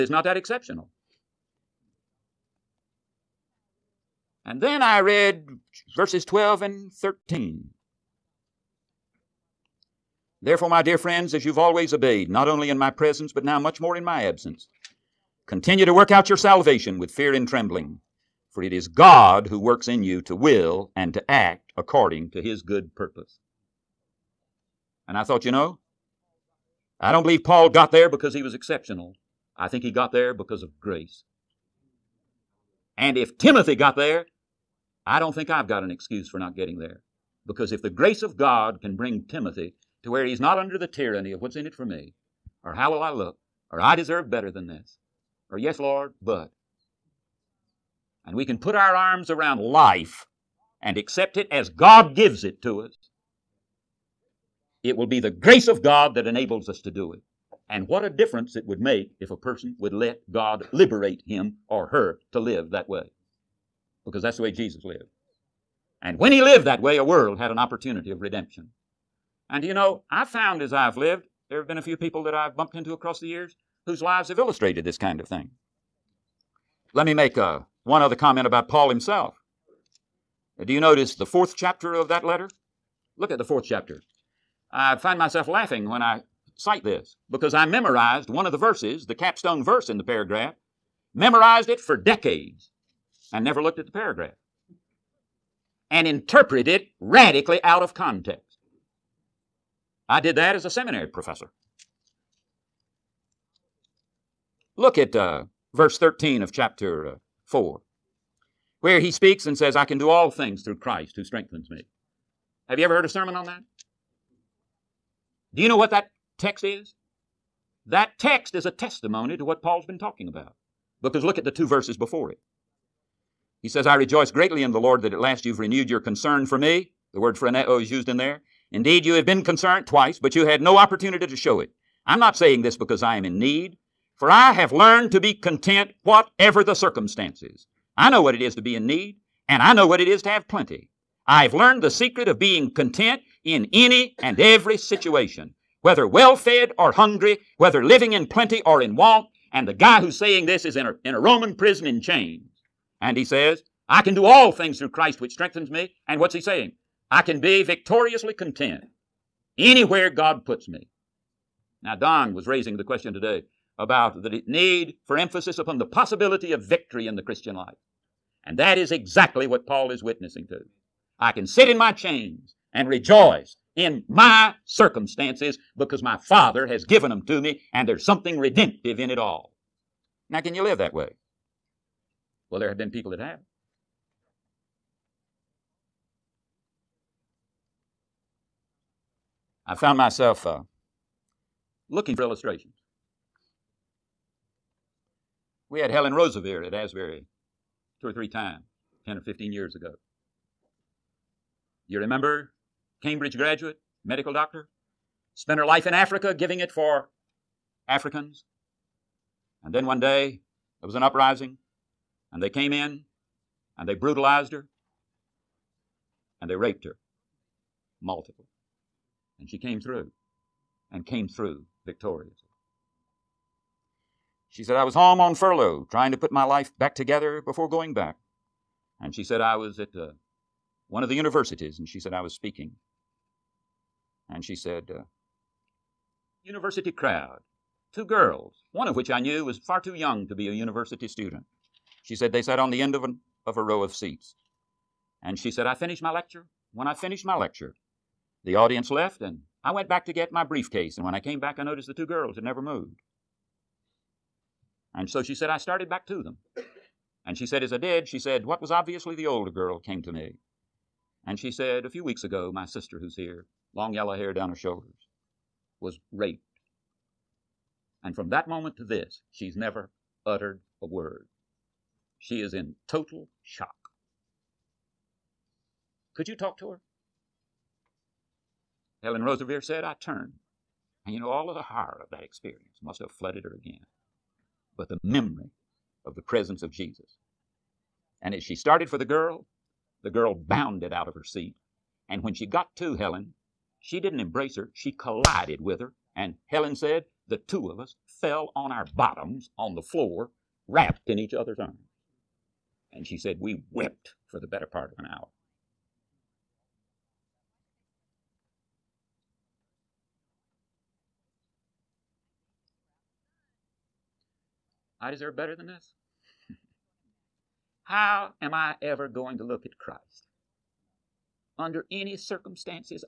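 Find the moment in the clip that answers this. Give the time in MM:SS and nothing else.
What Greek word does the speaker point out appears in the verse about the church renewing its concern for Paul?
02:07.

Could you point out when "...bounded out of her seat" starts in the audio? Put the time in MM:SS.
04:50.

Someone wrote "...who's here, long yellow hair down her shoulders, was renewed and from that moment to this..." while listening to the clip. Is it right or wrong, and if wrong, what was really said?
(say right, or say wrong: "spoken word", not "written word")
wrong: "raped", not "renewed".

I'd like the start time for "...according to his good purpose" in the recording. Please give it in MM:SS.
00:21.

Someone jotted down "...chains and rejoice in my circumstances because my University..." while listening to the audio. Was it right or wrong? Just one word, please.
wrong.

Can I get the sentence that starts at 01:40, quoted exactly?
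I did that as a seminary professor.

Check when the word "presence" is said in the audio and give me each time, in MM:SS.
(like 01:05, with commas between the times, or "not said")
00:12, 04:46.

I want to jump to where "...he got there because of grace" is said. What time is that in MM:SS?
00:29.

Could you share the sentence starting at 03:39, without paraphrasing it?
And she came through and came through victorious.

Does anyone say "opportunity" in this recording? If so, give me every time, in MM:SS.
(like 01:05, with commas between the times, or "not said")
01:07, 02:10.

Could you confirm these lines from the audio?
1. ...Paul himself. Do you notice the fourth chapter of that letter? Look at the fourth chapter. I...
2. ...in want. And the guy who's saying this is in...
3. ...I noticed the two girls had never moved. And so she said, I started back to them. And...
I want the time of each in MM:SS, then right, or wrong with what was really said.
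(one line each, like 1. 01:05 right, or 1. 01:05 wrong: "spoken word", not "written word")
1. 01:18 right
2. 02:28 right
3. 04:11 right.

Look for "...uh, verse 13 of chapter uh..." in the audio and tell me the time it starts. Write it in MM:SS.
01:45.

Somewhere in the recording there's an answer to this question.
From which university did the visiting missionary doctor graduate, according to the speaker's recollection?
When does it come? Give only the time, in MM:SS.
03:23.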